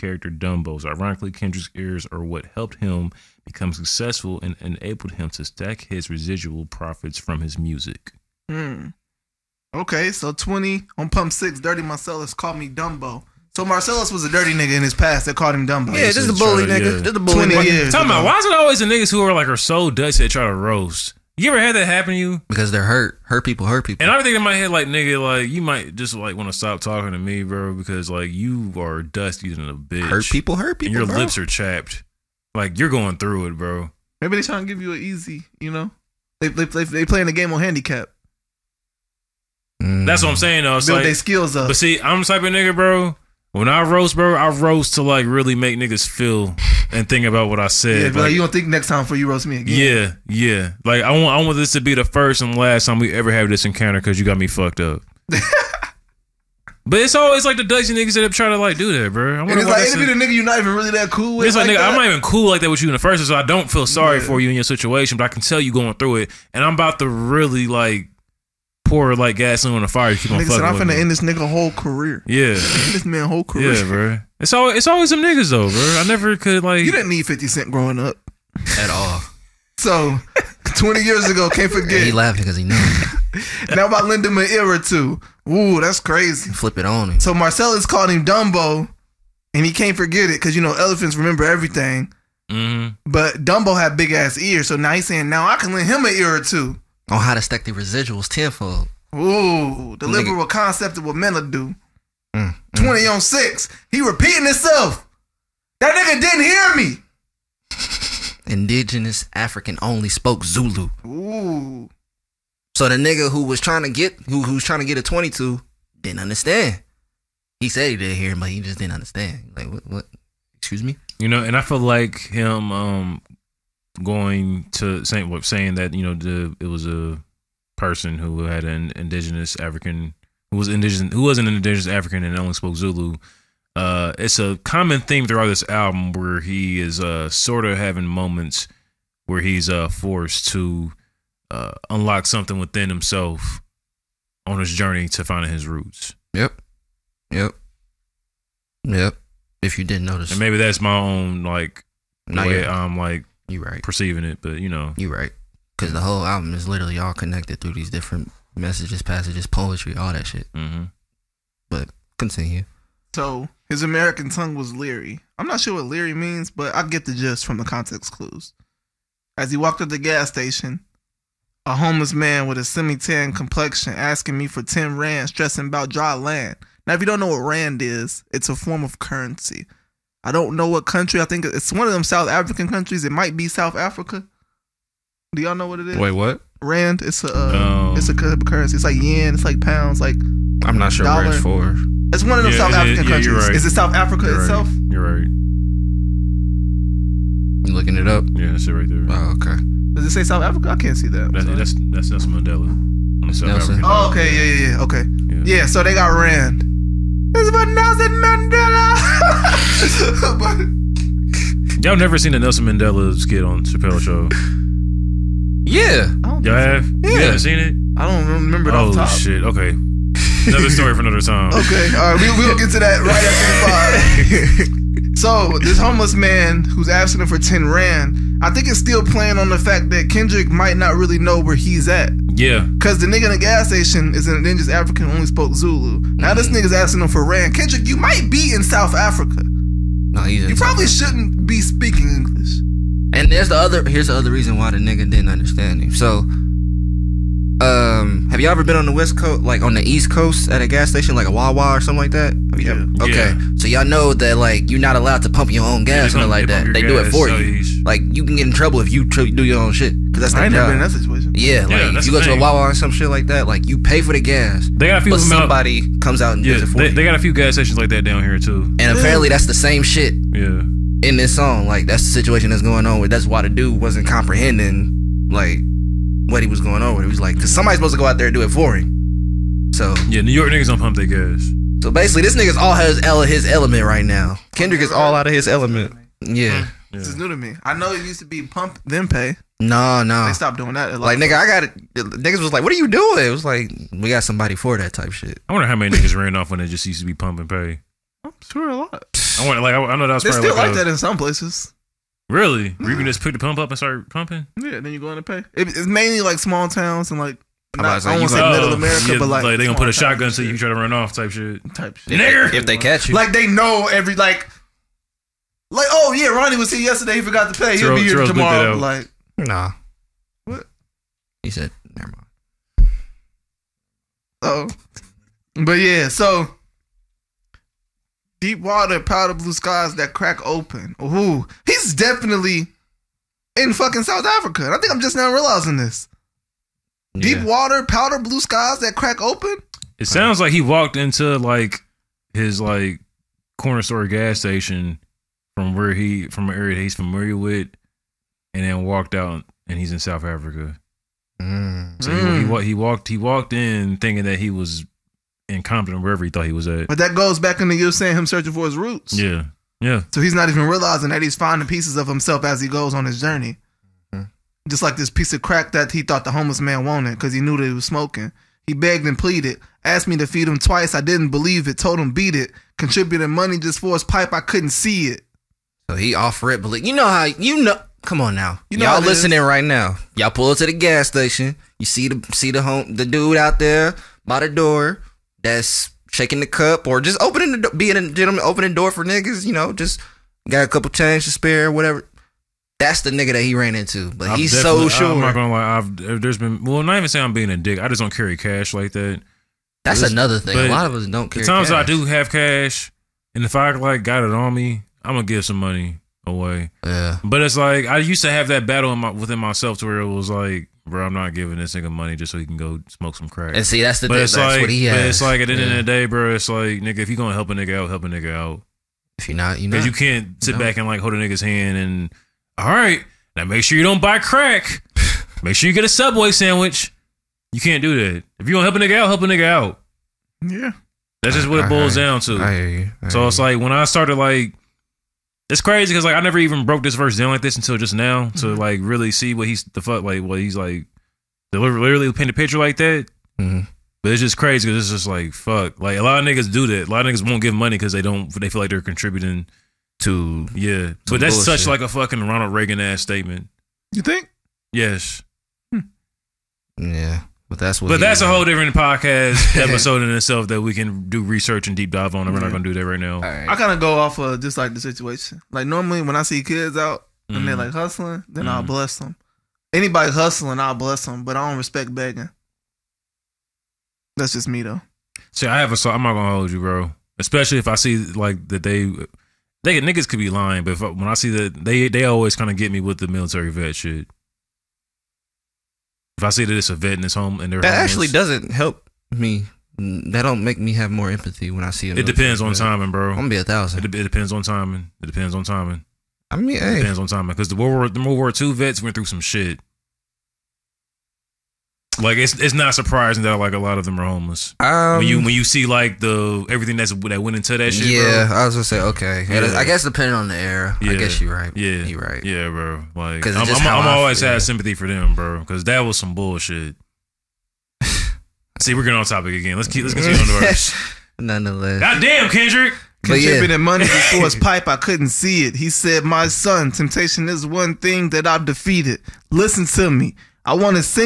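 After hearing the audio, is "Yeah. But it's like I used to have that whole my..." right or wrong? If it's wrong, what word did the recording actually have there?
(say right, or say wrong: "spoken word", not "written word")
wrong: "battle", not "whole".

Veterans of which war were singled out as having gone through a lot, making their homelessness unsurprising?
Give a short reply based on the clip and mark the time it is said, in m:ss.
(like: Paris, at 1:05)
World War II, at 8:18.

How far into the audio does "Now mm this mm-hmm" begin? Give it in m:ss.
3:56.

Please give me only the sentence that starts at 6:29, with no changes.
You know, just got a couple change to spare, whatever.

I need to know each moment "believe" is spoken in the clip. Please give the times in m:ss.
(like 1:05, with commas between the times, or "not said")
6:11, 6:16.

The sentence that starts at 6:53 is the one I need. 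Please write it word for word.
And see, that's the but thing.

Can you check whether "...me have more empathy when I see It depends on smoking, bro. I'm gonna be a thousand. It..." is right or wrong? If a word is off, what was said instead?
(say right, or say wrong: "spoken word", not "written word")
wrong: "timing", not "smoking".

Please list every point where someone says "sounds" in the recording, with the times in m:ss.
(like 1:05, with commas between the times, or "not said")
5:40.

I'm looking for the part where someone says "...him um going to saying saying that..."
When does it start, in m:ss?
2:02.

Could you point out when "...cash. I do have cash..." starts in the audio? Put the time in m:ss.
6:41.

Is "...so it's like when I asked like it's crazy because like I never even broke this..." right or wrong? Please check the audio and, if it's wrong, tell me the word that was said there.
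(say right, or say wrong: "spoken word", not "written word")
wrong: "started", not "asked".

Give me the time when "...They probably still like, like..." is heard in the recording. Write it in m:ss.
5:00.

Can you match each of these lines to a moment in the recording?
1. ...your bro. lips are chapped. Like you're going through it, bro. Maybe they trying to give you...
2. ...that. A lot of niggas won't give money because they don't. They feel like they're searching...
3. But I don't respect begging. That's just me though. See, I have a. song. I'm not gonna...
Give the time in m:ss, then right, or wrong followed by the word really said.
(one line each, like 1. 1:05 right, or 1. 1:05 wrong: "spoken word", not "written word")
1. 0:31 right
2. 7:26 wrong: "contributing", not "searching"
3. 7:51 right.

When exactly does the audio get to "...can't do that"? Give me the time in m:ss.
7:07.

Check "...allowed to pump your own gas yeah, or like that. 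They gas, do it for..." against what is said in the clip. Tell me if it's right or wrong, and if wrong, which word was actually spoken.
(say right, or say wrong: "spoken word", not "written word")
right.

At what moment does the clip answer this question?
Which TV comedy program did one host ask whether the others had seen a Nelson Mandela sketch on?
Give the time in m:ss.
3:33.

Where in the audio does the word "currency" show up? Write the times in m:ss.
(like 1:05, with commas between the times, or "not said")
2:58, 3:08.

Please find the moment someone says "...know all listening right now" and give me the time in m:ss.
6:18.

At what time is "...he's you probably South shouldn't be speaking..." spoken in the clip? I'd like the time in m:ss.
4:00.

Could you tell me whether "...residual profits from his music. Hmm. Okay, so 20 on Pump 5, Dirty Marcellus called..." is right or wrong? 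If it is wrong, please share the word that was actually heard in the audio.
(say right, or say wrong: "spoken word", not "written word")
wrong: "6", not "5".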